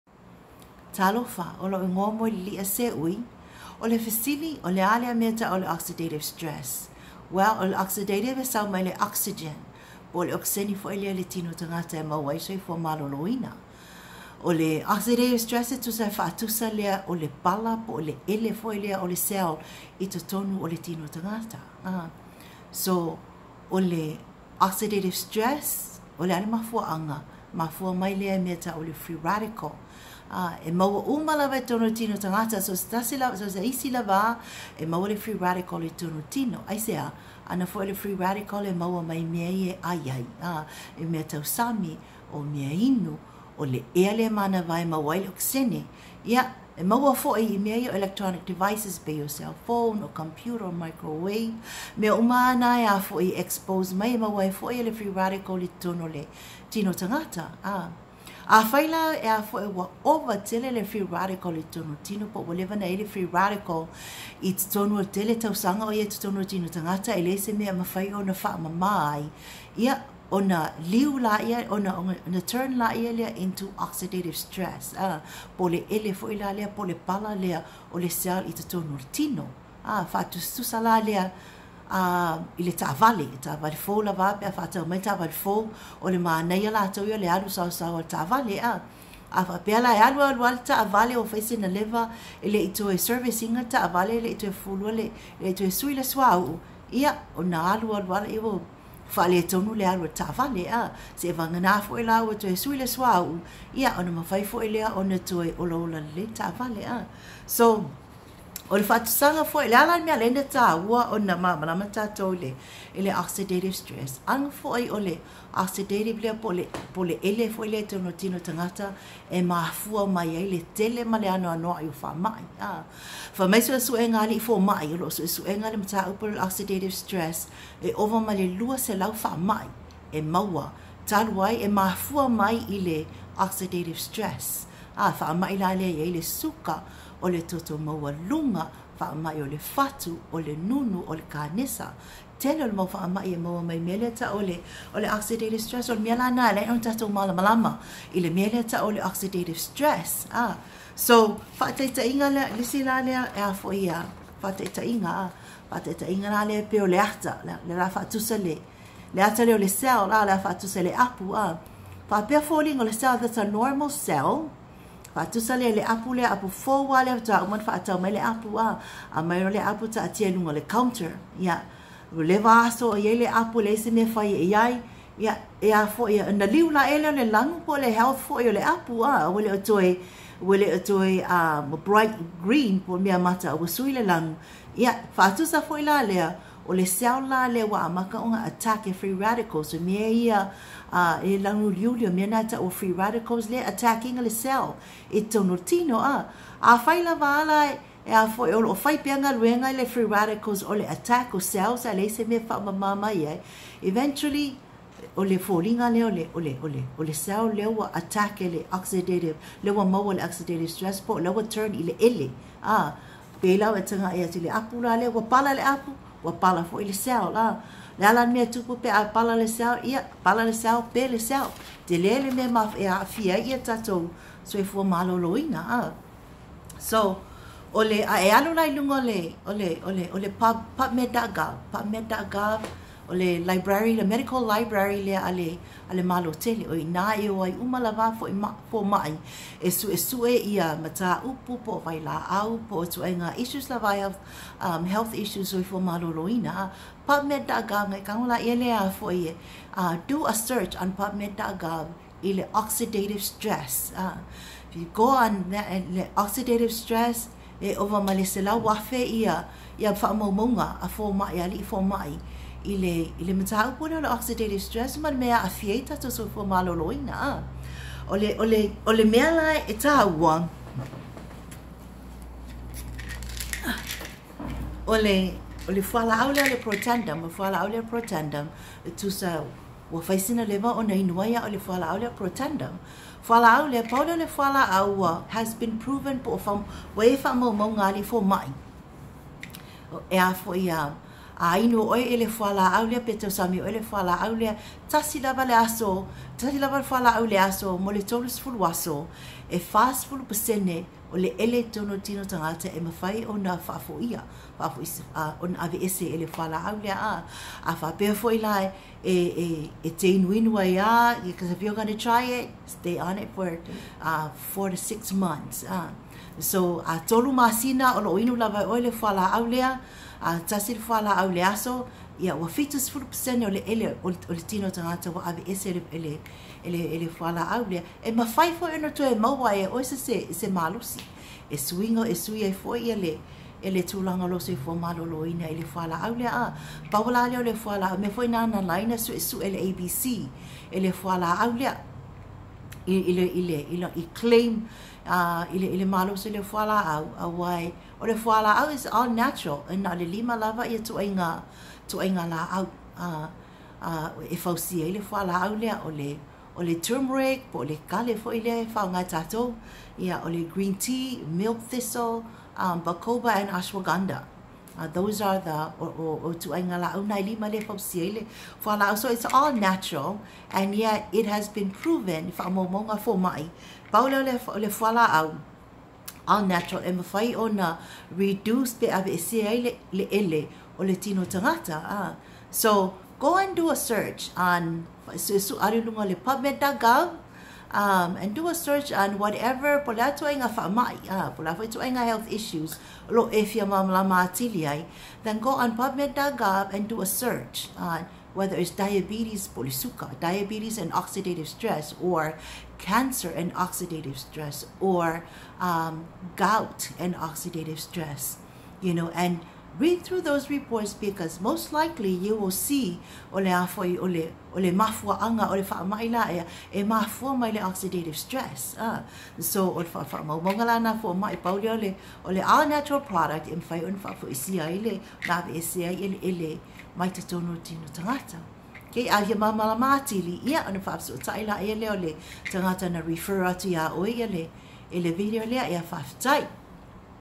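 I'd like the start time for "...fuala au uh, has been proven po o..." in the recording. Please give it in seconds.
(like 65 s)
284 s.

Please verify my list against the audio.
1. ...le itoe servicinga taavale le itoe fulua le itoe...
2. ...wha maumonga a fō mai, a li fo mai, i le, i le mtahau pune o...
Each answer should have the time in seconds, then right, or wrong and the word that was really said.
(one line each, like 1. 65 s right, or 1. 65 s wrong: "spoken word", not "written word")
1. 92 s right
2. 259 s right.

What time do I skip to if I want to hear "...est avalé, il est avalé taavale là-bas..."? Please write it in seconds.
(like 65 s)
81 s.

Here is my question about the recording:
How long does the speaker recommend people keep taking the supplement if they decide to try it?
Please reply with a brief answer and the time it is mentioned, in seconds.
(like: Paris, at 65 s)
four to six months, at 314 s.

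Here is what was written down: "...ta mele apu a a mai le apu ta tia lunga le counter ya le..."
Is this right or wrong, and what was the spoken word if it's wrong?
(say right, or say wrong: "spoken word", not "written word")
right.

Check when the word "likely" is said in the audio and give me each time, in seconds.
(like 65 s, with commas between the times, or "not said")
411 s.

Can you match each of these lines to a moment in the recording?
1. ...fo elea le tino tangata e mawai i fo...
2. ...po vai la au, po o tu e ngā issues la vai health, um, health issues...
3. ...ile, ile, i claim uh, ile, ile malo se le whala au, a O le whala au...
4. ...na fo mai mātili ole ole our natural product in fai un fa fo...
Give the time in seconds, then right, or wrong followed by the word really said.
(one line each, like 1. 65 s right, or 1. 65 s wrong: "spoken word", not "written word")
1. 10 s right
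2. 241 s right
3. 343 s right
4. 420 s wrong: "pauli", not "mātili".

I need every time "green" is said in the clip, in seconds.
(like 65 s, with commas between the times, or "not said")
182 s, 360 s.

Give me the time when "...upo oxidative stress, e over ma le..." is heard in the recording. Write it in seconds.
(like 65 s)
126 s.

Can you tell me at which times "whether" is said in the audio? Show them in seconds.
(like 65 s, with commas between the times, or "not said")
398 s.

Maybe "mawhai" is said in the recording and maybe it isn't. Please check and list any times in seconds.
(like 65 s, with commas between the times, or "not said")
302 s, 328 s.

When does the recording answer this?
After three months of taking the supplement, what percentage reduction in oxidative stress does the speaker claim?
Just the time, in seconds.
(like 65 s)
322 s.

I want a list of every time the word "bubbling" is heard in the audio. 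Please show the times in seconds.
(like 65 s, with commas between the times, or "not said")
not said.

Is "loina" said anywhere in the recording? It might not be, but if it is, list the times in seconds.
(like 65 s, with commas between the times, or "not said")
13 s, 225 s, 246 s.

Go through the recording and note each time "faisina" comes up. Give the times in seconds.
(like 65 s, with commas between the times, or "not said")
91 s, 280 s.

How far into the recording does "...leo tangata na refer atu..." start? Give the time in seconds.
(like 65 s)
431 s.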